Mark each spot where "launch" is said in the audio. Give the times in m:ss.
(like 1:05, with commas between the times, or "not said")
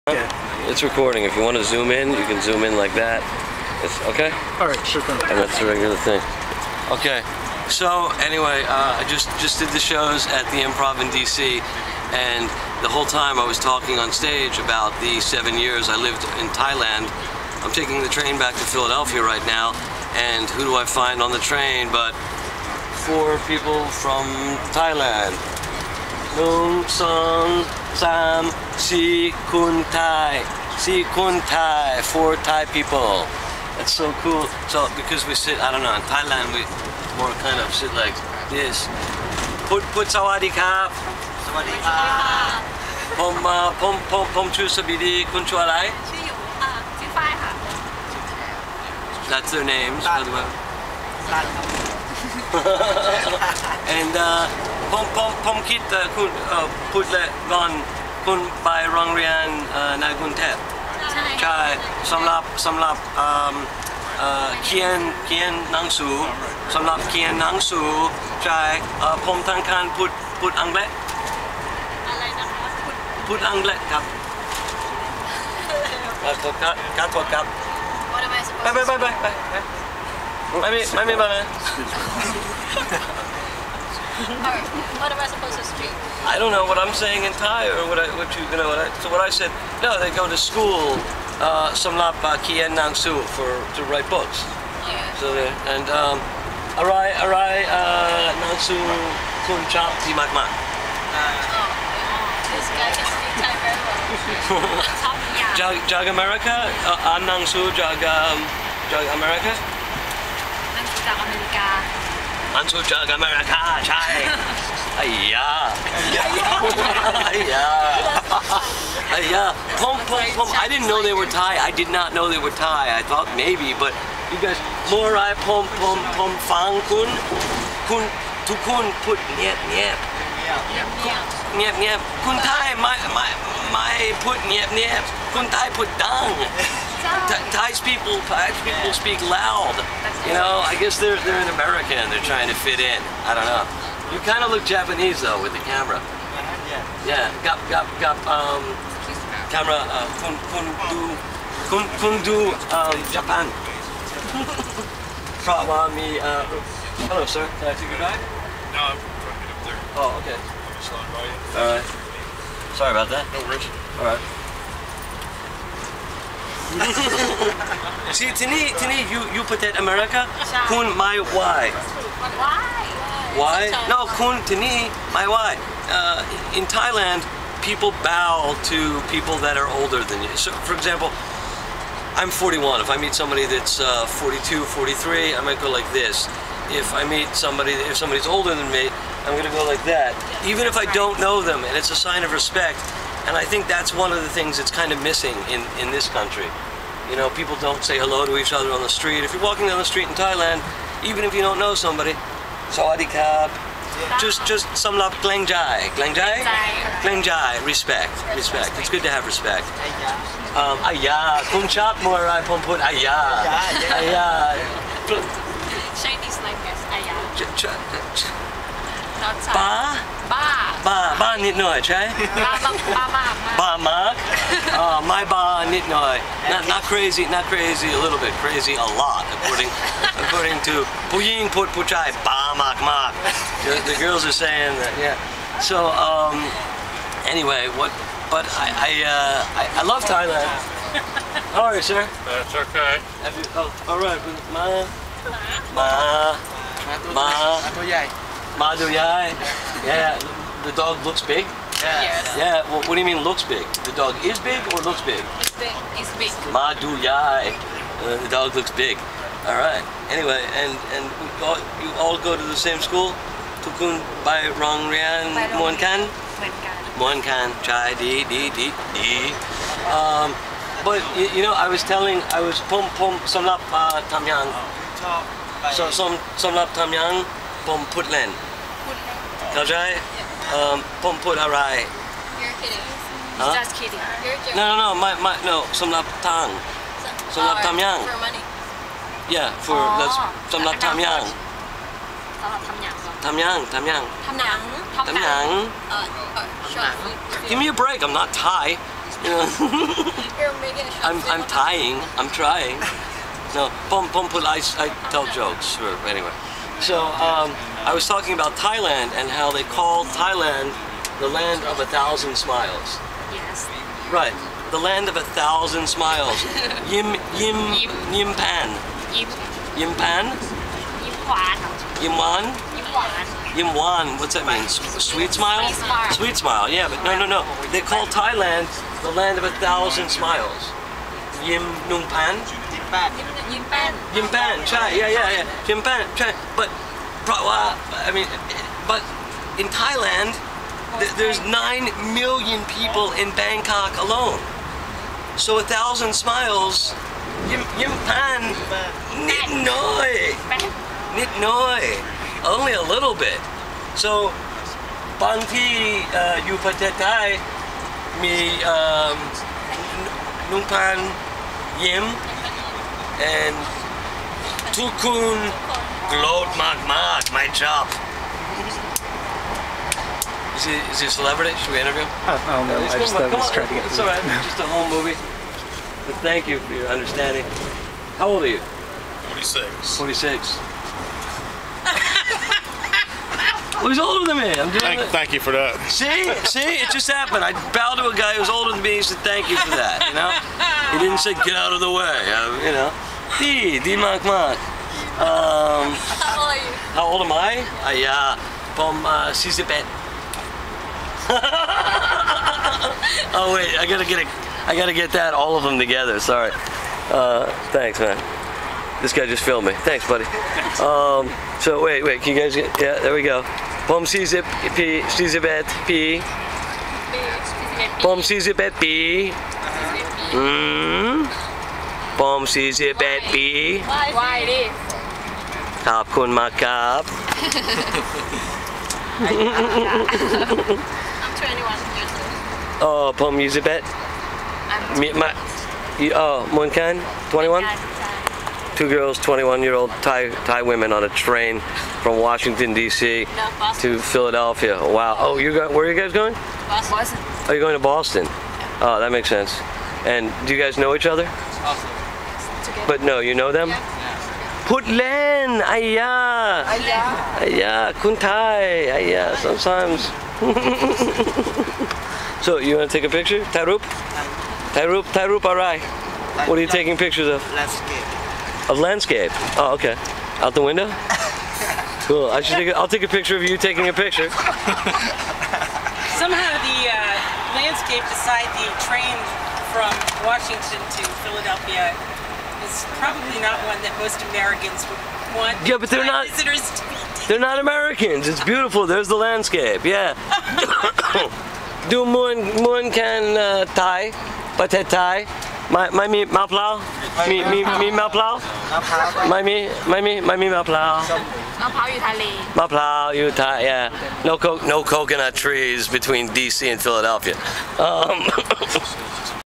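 not said.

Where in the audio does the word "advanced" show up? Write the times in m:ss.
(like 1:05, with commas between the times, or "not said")
not said.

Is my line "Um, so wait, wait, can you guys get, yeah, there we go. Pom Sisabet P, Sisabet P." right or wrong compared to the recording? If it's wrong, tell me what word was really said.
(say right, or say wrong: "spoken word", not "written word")
right.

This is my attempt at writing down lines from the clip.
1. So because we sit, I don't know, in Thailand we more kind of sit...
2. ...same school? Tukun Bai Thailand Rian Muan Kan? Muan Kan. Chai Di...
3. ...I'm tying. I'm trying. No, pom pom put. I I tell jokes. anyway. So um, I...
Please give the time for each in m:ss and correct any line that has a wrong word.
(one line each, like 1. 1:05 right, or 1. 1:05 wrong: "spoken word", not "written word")
1. 0:34 right
2. 4:22 wrong: "Rong", not "Thailand"
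3. 5:01 right.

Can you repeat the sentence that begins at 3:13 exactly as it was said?
And I think that's one of the things that's kind of missing in, in this country.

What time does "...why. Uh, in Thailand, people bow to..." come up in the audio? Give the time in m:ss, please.
2:55.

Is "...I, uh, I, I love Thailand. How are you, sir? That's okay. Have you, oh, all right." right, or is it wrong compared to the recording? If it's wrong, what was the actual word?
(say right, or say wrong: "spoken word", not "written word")
right.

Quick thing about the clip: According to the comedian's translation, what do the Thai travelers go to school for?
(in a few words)
To write books.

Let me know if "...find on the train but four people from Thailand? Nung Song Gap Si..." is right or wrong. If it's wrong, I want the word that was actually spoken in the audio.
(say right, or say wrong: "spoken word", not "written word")
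wrong: "Sam", not "Gap".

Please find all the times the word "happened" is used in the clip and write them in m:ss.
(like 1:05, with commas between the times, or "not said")
6:27.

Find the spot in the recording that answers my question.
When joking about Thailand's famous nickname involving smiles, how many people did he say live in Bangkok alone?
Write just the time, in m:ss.
5:41.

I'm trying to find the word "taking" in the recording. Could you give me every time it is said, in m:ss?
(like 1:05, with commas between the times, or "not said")
0:17, 7:46, 7:53.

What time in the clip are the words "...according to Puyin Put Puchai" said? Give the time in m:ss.
3:50.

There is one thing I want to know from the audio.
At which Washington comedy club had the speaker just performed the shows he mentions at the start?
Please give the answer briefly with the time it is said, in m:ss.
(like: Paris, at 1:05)
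The Improv, at 0:10.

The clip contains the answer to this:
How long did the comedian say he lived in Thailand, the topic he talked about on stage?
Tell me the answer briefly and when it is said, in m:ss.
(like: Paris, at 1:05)
7 years, at 0:15.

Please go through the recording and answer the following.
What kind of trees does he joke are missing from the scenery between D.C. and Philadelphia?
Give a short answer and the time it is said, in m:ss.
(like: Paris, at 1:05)
Coconut trees, at 8:24.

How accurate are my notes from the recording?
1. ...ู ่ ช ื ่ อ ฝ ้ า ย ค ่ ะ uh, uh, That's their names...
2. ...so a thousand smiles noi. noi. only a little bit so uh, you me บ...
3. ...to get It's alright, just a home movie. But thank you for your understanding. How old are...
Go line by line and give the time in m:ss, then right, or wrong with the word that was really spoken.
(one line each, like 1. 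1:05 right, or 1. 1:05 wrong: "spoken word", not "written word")
1. 0:46 right
2. 5:45 right
3. 6:13 right.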